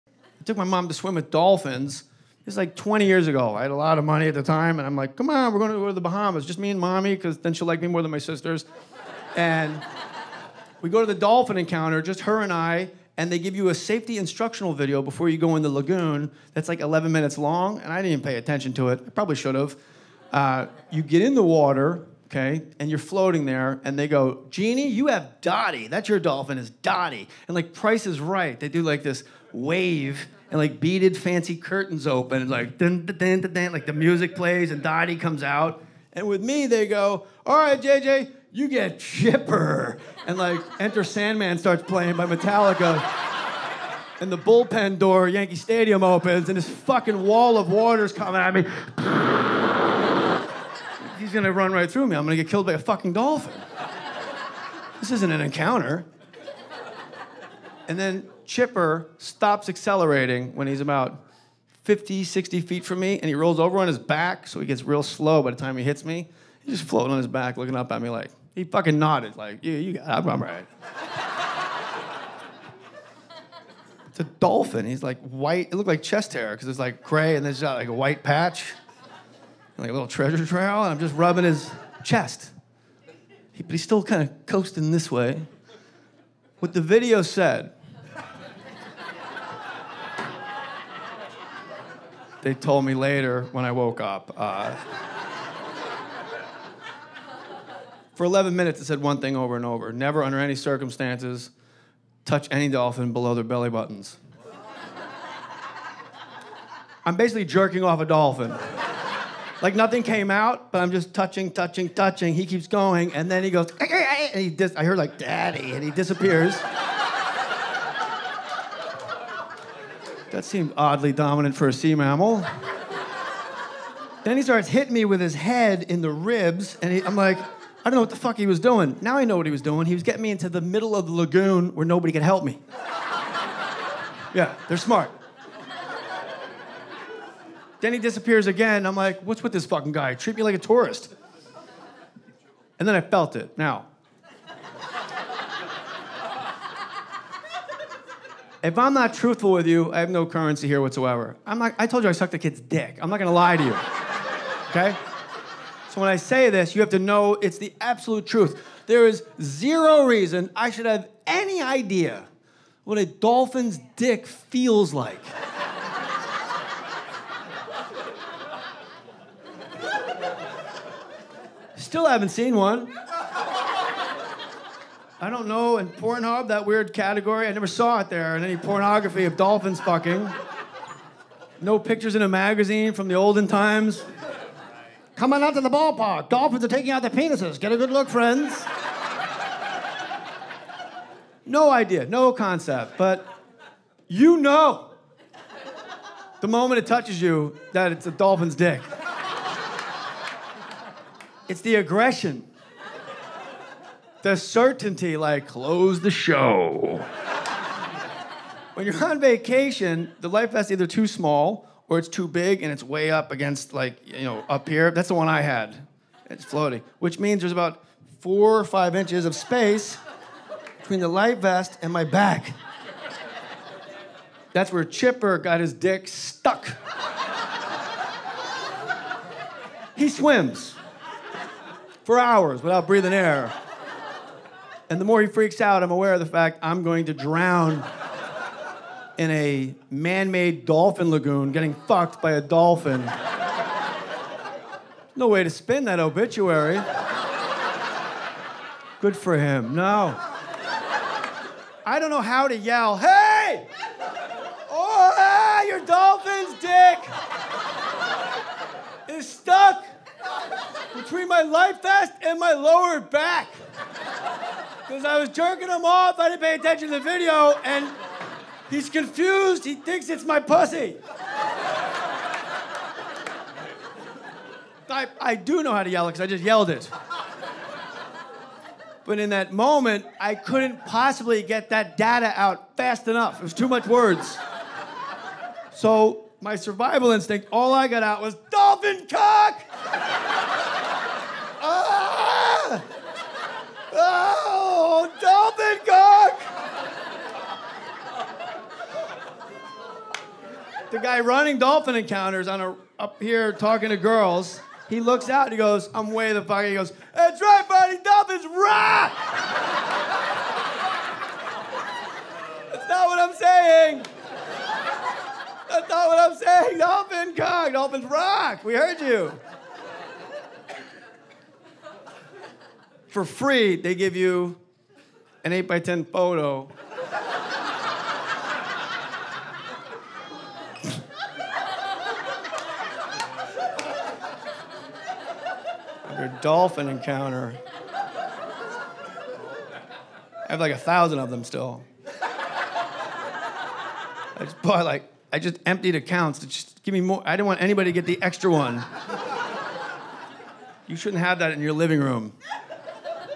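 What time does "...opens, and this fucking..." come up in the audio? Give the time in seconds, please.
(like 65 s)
46 s.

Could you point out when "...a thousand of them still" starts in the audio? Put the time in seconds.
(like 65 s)
340 s.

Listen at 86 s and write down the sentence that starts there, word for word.
What the video said They told me later when I woke up.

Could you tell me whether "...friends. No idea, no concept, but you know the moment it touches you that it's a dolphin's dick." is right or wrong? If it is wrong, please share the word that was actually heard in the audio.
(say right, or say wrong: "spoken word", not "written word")
right.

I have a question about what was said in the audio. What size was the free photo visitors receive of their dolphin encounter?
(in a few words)
8 by 10.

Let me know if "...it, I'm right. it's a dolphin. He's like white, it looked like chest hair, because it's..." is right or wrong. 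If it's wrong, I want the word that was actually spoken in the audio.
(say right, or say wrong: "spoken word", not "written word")
right.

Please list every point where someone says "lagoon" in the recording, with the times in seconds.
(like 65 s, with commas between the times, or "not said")
15 s, 131 s, 241 s.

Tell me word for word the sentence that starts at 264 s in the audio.
Because I was jerking him off, I didn't pay attention to the video, and he's confused.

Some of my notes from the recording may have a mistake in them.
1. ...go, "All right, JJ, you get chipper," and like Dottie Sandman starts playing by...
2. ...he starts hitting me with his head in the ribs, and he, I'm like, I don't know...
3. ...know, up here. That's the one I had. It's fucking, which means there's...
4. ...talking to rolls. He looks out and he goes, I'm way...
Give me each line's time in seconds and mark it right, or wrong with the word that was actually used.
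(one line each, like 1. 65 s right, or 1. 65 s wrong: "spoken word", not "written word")
1. 36 s wrong: "Enter", not "Dottie"
2. 124 s right
3. 214 s wrong: "floating", not "fucking"
4. 303 s wrong: "girls", not "rolls".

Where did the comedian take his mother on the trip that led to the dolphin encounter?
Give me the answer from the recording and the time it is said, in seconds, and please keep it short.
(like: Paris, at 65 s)
The Bahamas, at 5 s.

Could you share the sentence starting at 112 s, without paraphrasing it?
He keeps going, and then he goes, and he dis- I hear like, Daddy, and he disappears.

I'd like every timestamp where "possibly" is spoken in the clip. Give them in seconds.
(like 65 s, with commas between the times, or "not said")
280 s.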